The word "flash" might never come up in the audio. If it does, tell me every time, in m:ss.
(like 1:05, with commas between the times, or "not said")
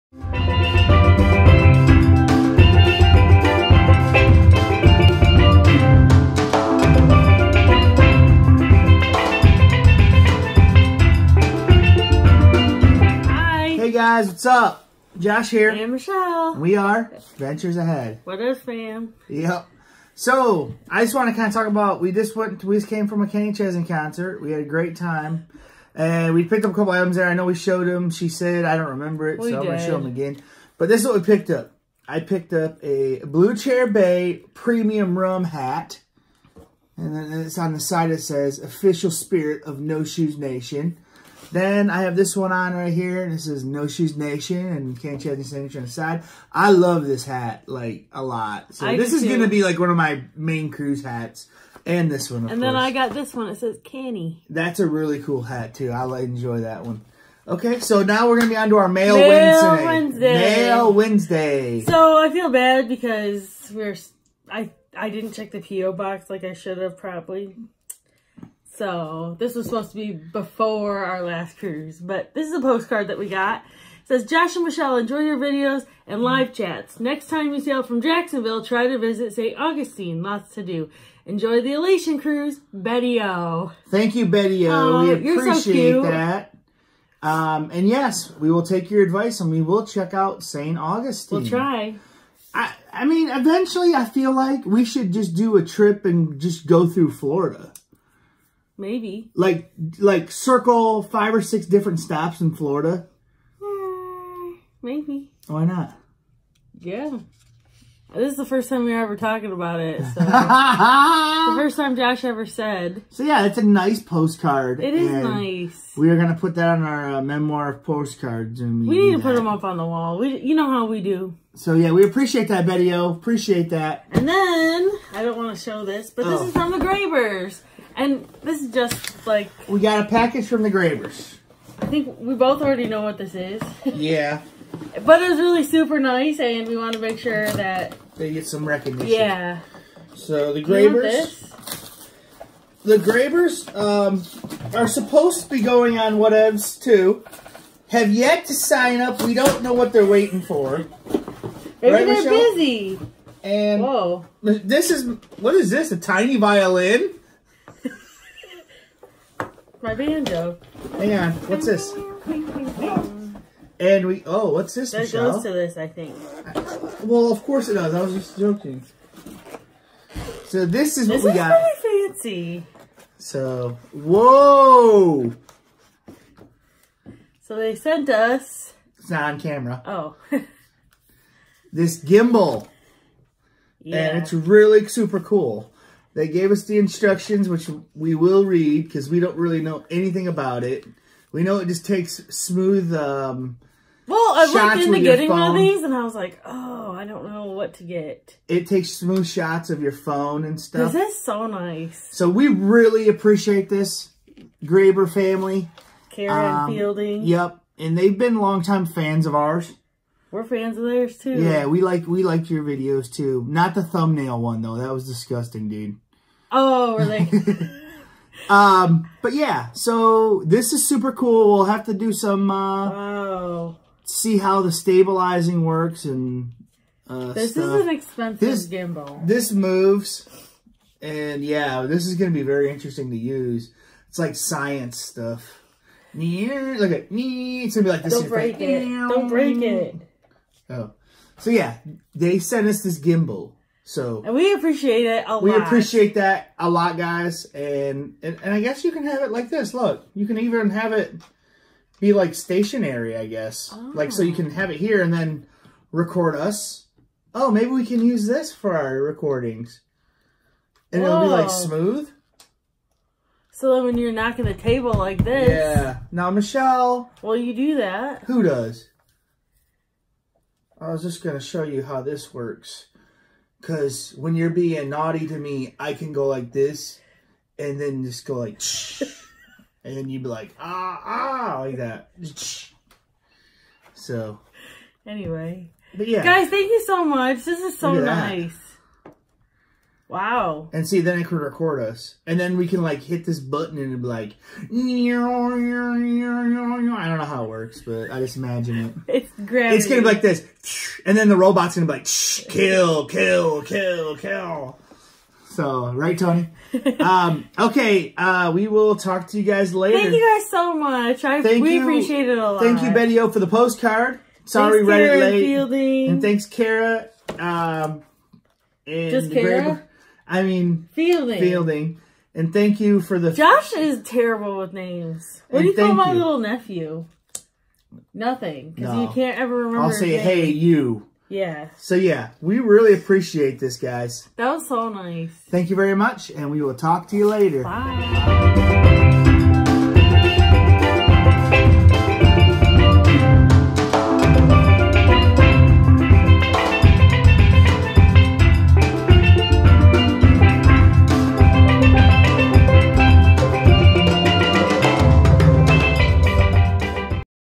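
not said.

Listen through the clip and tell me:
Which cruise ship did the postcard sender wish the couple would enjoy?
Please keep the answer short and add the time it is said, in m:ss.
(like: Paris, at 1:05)
Elation, at 1:21.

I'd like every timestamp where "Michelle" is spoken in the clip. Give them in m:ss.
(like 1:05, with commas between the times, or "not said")
0:15, 1:14, 2:32, 2:45, 4:26.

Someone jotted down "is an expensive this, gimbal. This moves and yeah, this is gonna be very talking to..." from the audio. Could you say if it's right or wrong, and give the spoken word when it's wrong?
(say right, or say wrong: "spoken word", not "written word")
wrong: "interesting", not "talking".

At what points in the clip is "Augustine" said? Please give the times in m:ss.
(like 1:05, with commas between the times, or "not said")
1:19, 1:30.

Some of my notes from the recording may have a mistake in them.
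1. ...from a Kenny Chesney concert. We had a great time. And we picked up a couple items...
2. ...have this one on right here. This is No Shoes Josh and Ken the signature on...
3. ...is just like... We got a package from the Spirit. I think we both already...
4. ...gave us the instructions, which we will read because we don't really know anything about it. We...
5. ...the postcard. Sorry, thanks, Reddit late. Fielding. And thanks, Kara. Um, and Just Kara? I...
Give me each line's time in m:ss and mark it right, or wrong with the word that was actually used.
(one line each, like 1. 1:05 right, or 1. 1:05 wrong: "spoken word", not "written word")
1. 0:23 right
2. 0:42 wrong: "Nation", not "Josh"
3. 2:08 wrong: "Gravers", not "Spirit"
4. 3:06 right
5. 5:13 right.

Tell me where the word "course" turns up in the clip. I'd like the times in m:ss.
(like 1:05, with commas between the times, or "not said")
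0:52, 2:47.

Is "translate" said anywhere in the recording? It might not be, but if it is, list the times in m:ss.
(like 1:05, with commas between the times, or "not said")
not said.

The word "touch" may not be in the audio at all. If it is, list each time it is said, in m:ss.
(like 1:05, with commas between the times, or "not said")
not said.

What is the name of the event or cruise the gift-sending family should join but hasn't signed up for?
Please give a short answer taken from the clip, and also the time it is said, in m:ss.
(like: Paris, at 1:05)
Whatevs, at 2:26.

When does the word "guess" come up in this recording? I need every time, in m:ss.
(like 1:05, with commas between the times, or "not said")
4:08, 4:13.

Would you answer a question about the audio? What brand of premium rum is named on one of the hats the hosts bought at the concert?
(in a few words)
Blue Chair Bay.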